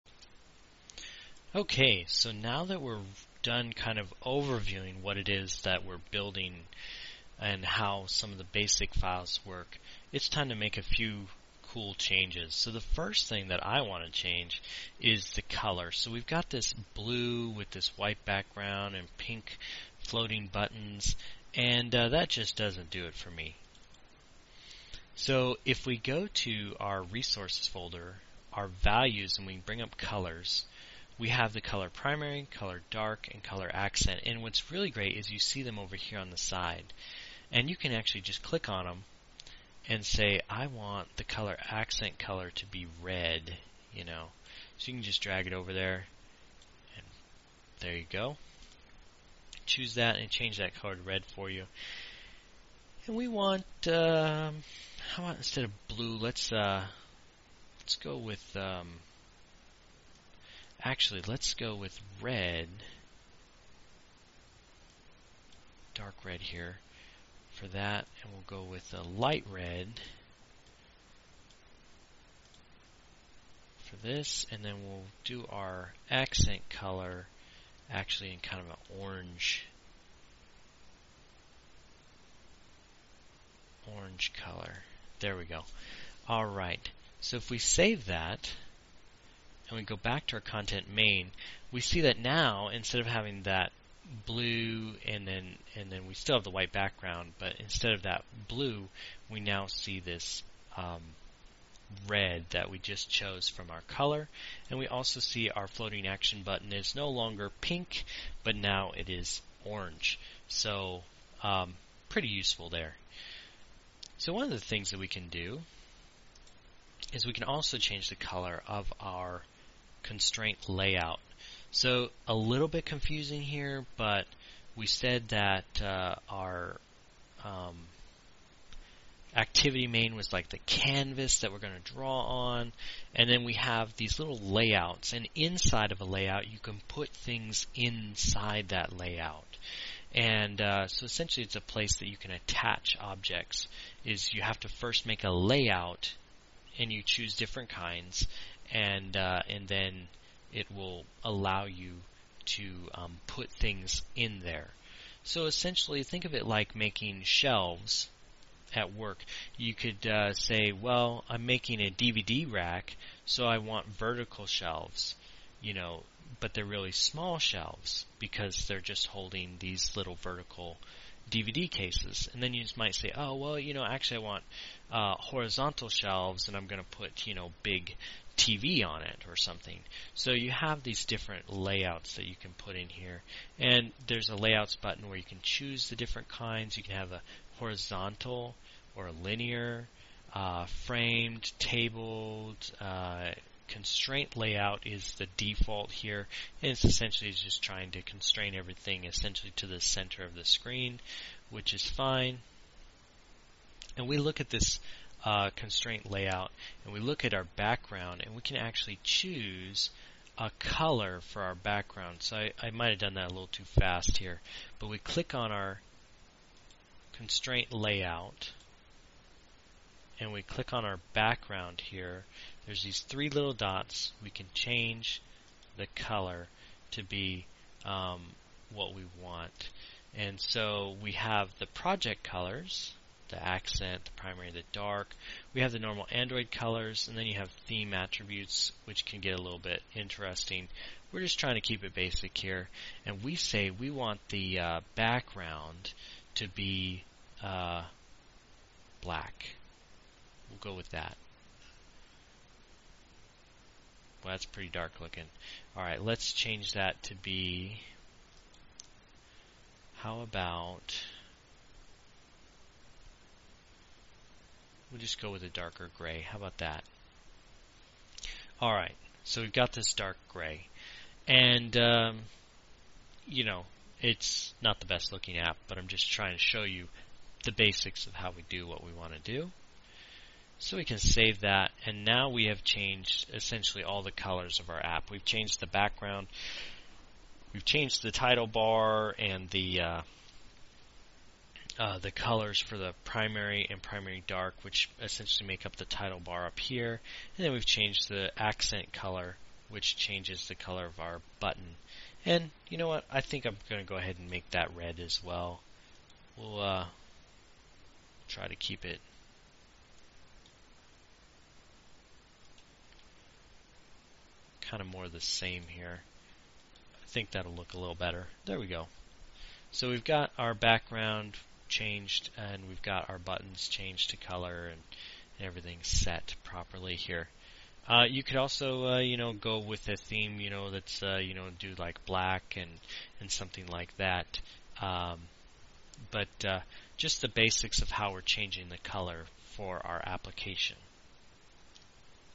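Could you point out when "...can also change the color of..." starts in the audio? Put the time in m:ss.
1:57.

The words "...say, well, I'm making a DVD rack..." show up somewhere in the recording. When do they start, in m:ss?
2:40.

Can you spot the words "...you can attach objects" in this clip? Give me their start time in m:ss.
2:22.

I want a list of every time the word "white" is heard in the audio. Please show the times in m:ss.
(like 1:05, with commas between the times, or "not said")
0:17, 1:36.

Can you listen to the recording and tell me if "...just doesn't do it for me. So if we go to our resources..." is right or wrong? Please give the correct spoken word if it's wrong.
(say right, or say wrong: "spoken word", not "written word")
right.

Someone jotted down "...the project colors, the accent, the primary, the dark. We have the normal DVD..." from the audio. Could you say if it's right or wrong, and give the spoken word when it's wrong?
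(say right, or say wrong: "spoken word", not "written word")
wrong: "Android", not "DVD".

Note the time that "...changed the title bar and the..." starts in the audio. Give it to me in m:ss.
4:47.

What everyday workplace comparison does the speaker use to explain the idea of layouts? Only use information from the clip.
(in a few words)
making shelves.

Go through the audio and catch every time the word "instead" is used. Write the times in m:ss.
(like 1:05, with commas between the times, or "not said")
0:55, 1:32, 1:37.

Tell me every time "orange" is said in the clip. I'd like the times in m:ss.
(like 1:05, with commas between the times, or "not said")
1:18, 1:23, 1:49.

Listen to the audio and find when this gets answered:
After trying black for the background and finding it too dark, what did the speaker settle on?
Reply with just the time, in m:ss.
4:25.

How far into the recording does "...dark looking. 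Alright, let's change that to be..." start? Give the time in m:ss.
4:14.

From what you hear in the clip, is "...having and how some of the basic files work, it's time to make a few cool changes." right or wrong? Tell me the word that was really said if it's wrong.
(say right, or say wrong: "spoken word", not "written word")
wrong: "building", not "having".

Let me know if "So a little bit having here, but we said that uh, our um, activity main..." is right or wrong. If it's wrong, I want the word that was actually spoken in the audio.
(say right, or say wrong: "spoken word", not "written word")
wrong: "confusing", not "having".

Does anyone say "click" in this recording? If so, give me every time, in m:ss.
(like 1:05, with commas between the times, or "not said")
0:38, 3:34, 3:40.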